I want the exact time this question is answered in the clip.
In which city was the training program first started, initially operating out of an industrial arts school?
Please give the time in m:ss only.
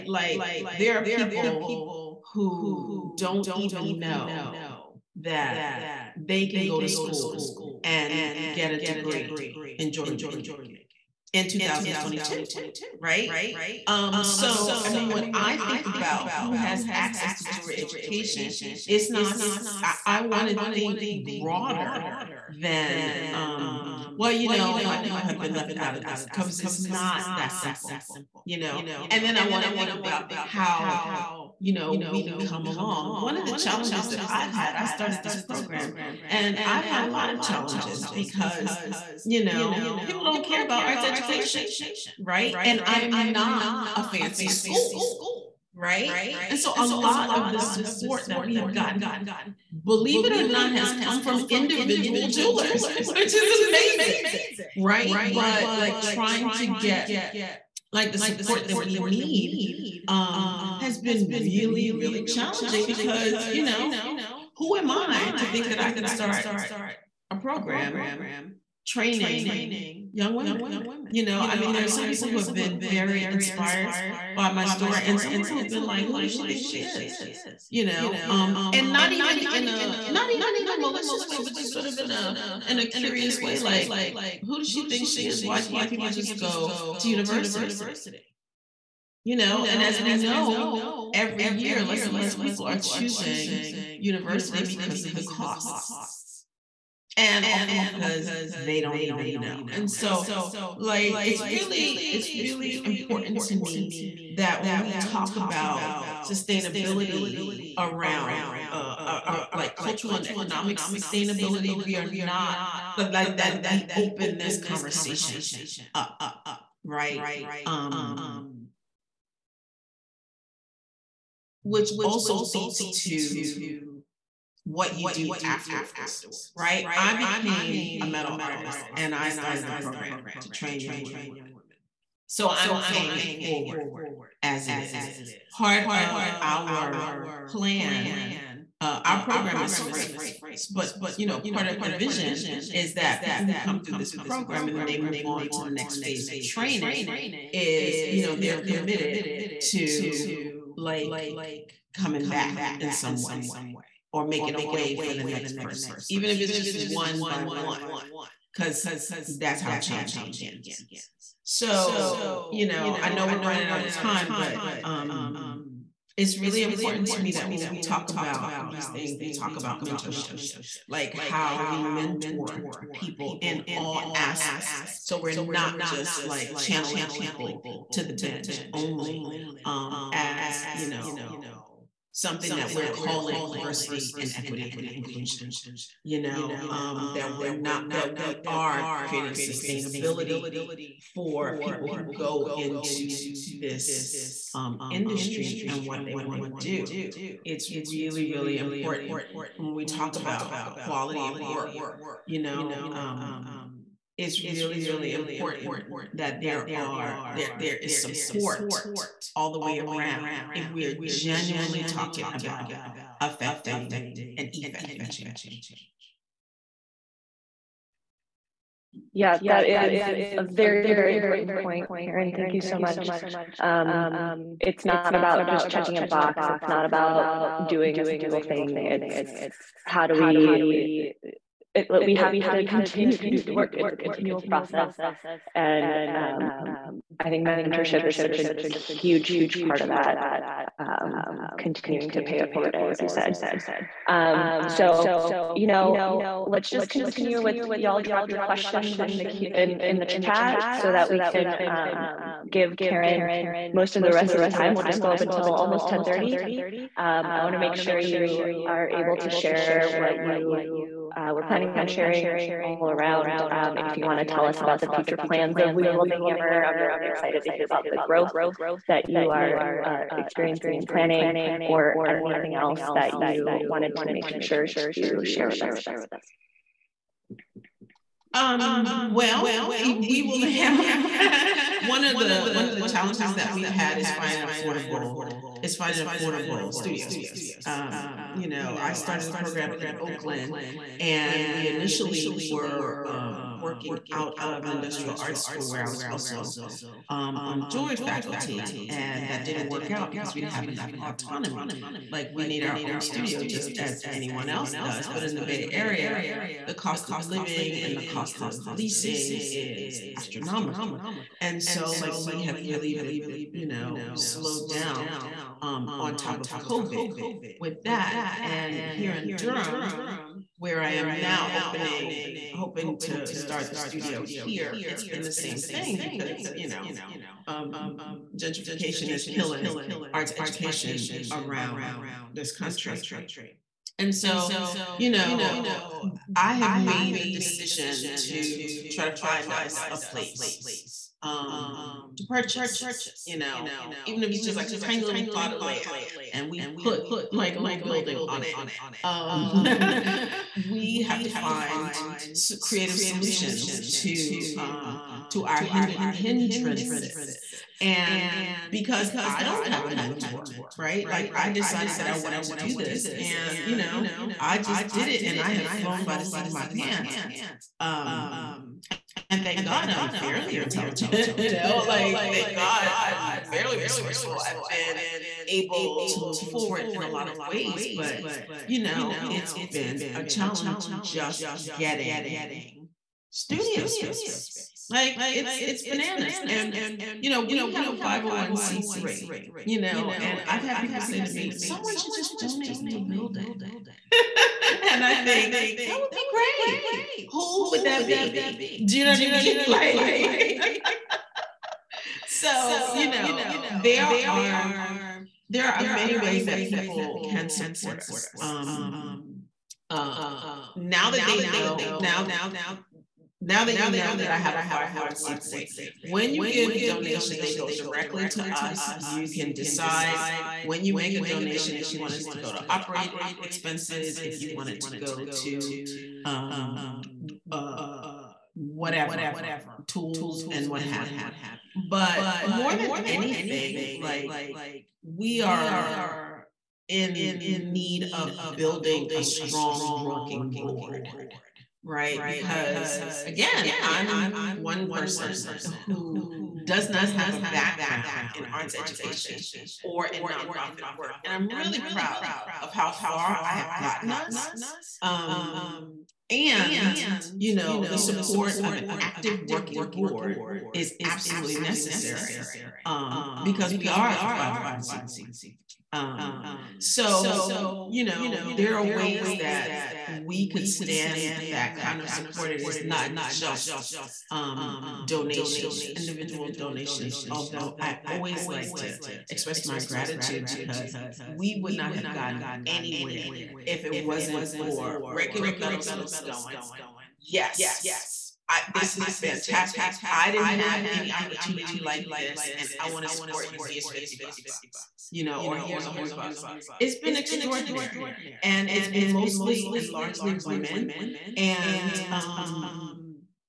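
4:49.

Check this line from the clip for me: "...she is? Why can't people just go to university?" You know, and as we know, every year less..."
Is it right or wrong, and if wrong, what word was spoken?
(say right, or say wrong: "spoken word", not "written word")
right.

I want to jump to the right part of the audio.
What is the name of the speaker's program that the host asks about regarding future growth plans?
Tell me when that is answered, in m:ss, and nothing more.
4:25.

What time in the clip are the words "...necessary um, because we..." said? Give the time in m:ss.
7:41.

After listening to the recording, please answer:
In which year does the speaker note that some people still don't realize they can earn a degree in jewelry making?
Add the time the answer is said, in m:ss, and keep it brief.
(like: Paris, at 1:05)
2022, at 0:11.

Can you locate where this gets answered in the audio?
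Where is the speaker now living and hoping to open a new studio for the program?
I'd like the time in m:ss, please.
5:19.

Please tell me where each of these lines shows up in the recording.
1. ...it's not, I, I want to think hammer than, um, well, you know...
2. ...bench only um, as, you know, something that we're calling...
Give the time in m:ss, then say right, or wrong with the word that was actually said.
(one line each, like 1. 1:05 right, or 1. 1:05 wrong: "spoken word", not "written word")
1. 0:18 wrong: "broader", not "hammer"
2. 2:58 right.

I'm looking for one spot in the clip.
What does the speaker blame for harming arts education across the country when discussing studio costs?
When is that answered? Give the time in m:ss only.
5:28.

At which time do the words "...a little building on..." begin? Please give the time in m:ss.
5:47.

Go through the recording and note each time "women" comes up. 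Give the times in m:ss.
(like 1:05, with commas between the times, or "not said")
1:10, 2:10, 8:20.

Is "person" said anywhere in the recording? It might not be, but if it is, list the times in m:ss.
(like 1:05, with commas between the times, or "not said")
2:35, 7:24.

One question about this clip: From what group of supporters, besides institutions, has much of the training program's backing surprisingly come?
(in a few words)
individual jewelers.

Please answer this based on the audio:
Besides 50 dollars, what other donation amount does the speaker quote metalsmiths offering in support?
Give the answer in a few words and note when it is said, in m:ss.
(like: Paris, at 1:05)
100 bucks, at 8:15.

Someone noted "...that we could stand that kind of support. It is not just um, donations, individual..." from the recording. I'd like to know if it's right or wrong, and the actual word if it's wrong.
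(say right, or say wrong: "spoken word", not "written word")
right.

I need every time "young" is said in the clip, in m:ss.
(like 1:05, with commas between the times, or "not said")
1:10, 2:10.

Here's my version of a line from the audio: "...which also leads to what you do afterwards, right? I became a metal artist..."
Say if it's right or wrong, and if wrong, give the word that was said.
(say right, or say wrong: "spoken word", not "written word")
right.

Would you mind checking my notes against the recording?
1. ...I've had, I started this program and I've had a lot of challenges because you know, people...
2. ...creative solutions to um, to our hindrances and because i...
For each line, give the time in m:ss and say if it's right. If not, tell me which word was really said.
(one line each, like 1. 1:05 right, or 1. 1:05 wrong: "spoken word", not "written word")
1. 0:34 right
2. 5:52 right.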